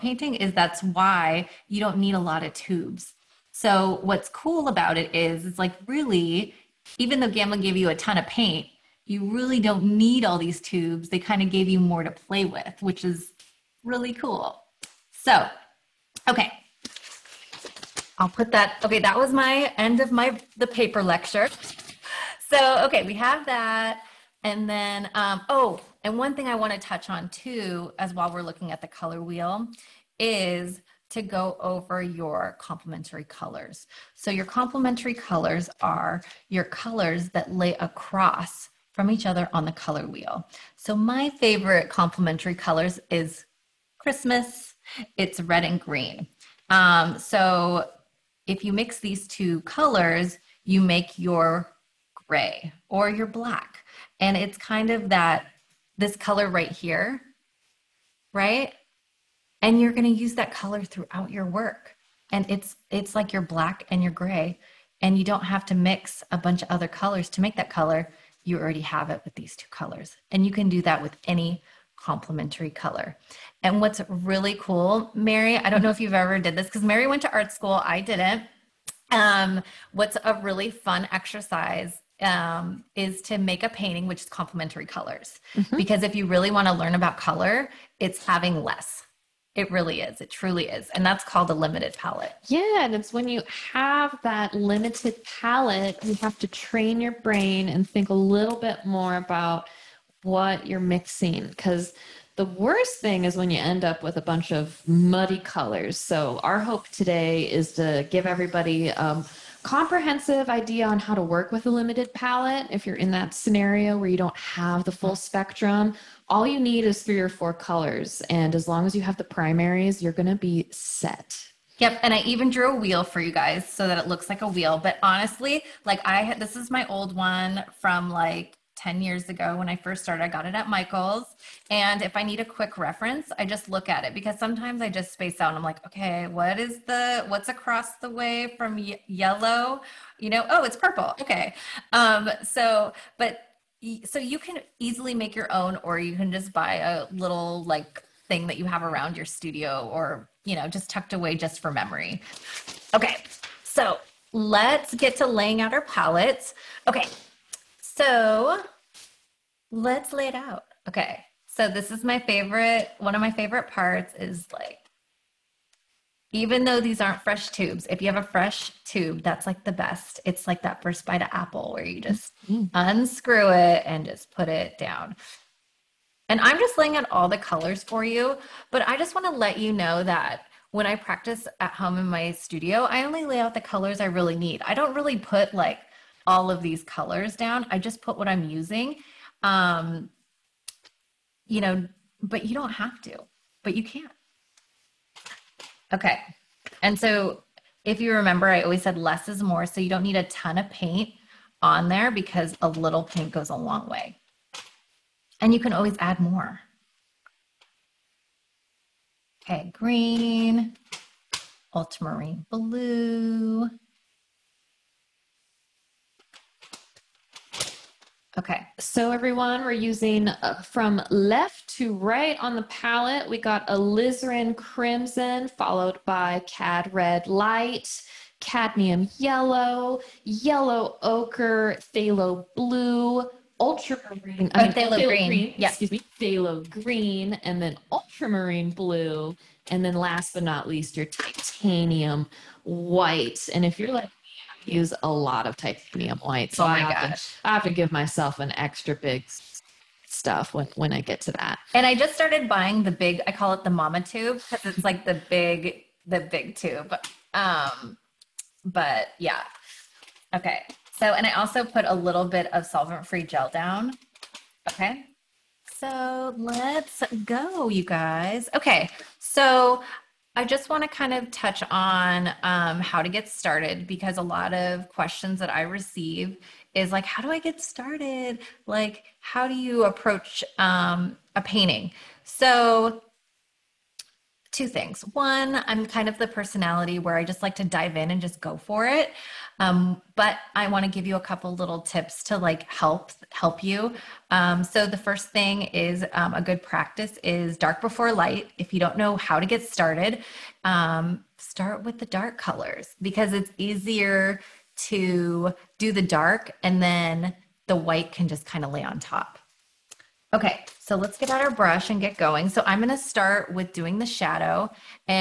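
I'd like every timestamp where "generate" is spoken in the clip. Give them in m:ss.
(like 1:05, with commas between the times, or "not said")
not said.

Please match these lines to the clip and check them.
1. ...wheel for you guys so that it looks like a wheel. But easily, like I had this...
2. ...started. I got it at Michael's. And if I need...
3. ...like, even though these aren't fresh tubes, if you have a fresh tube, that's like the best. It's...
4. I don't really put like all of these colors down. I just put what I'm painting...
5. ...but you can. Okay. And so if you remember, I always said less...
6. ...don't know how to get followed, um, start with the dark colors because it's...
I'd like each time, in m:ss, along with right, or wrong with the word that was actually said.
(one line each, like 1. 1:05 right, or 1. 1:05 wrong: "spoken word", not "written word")
1. 2:02 wrong: "honestly", not "easily"
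2. 2:10 right
3. 2:44 right
4. 3:04 wrong: "using", not "painting"
5. 3:13 right
6. 4:58 wrong: "started", not "followed".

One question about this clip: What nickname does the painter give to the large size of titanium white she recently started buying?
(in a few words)
mama tube.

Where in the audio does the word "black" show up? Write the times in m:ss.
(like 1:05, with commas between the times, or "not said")
0:53, 1:03.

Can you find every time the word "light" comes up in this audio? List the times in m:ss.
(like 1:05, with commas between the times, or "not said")
3:47, 4:58.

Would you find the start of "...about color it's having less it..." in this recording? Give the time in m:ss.
1:26.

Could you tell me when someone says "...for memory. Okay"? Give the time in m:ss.
2:31.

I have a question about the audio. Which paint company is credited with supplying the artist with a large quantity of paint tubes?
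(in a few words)
Gamblin.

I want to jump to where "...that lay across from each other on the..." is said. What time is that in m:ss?
0:37.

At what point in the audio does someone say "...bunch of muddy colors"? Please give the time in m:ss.
1:44.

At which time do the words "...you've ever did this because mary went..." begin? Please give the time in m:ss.
1:15.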